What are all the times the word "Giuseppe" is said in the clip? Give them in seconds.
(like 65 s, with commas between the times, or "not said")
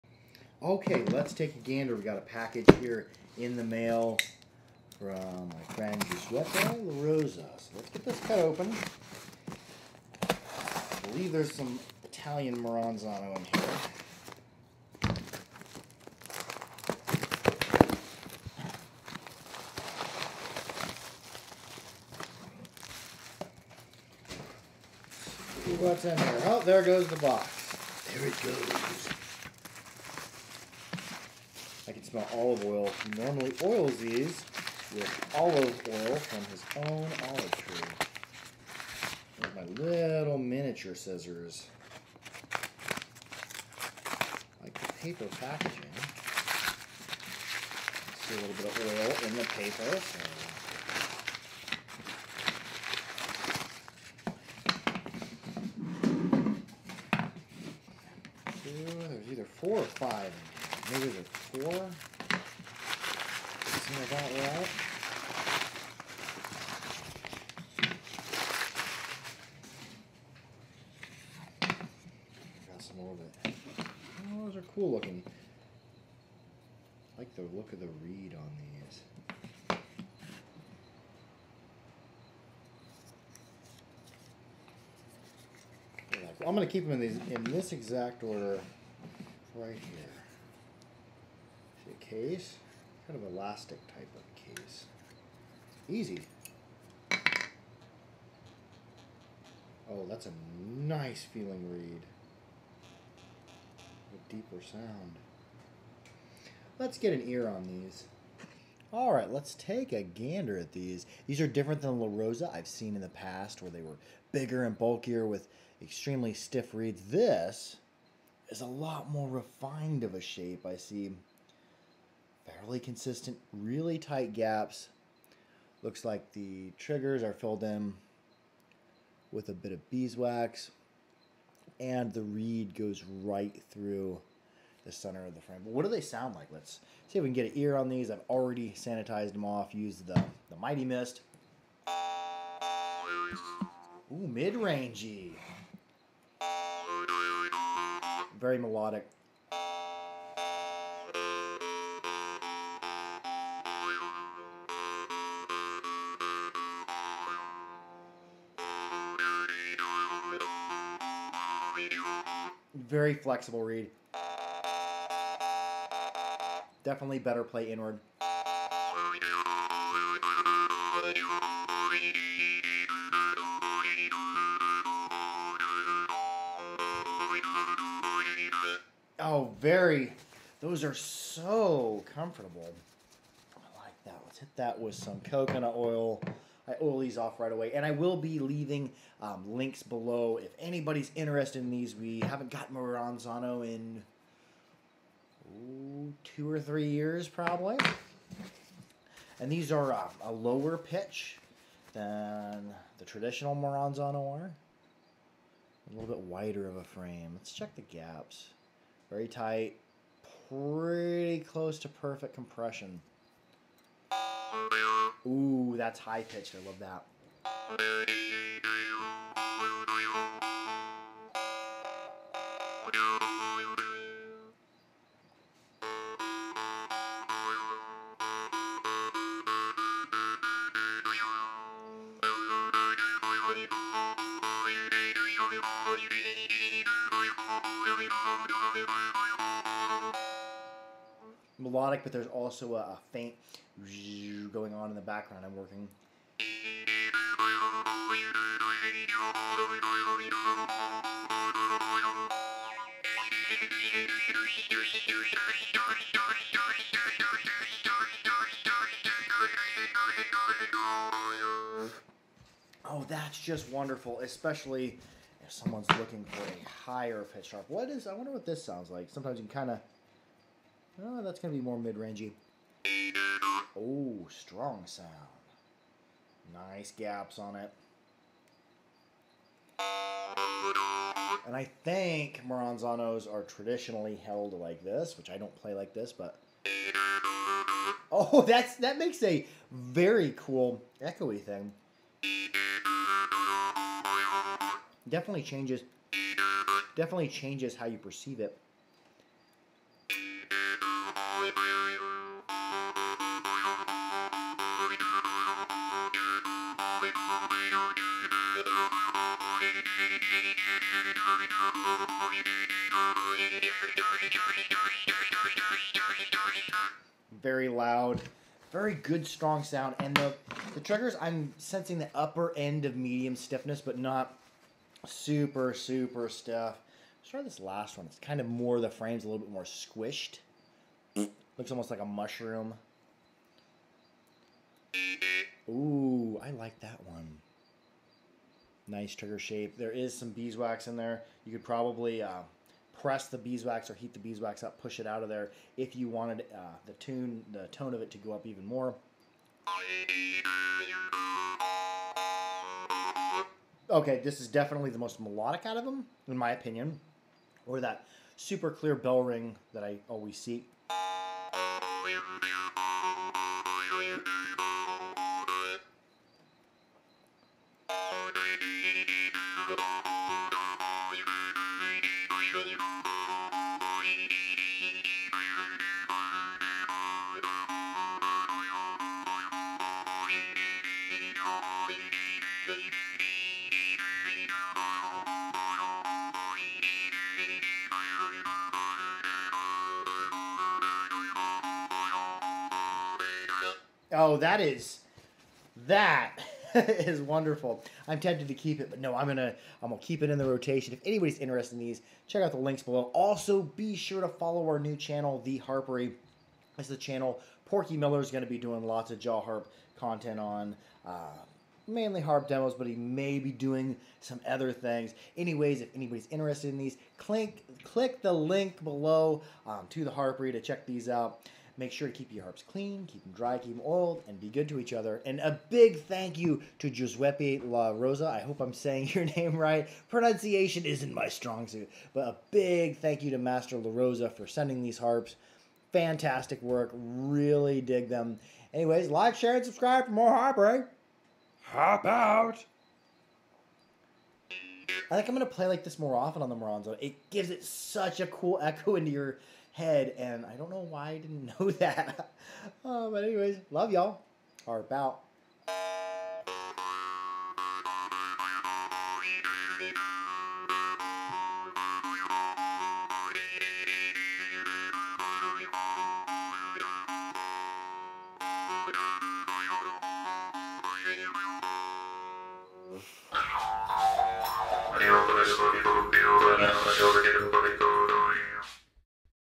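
6 s, 426 s.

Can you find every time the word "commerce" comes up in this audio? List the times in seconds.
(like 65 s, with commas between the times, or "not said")
not said.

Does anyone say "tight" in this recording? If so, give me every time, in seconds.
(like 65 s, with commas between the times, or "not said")
123 s, 209 s.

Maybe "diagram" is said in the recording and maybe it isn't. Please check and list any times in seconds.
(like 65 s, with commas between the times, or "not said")
not said.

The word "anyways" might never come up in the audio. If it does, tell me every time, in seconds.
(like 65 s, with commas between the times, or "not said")
415 s, 438 s, 453 s.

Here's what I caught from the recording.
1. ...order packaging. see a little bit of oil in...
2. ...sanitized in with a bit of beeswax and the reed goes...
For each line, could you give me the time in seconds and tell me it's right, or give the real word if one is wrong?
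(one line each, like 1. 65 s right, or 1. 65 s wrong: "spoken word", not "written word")
1. 45 s wrong: "paper", not "order"
2. 127 s wrong: "filled", not "sanitized".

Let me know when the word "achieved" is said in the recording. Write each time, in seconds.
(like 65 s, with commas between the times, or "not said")
not said.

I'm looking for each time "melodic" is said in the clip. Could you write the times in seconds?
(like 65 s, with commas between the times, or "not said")
148 s, 241 s, 355 s.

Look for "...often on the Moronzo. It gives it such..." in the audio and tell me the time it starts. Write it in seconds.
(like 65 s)
446 s.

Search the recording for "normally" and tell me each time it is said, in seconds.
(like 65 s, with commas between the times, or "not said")
33 s.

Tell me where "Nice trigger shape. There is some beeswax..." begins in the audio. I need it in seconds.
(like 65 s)
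338 s.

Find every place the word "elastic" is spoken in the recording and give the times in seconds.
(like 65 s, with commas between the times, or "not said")
93 s.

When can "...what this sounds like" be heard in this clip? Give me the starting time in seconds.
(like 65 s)
268 s.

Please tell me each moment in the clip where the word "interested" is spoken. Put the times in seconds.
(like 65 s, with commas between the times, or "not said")
191 s, 401 s, 416 s.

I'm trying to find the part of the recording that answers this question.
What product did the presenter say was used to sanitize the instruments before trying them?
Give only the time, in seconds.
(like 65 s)
140 s.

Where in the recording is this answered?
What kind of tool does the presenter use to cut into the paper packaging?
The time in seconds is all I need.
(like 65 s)
40 s.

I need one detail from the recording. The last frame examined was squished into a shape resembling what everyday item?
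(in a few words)
A mushroom.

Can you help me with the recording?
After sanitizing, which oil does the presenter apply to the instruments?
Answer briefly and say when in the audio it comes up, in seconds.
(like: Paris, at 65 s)
Coconut oil, at 185 s.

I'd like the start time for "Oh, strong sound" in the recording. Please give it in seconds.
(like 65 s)
273 s.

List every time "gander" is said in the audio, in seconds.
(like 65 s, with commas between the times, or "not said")
1 s, 110 s.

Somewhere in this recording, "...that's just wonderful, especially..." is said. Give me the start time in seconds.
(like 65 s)
263 s.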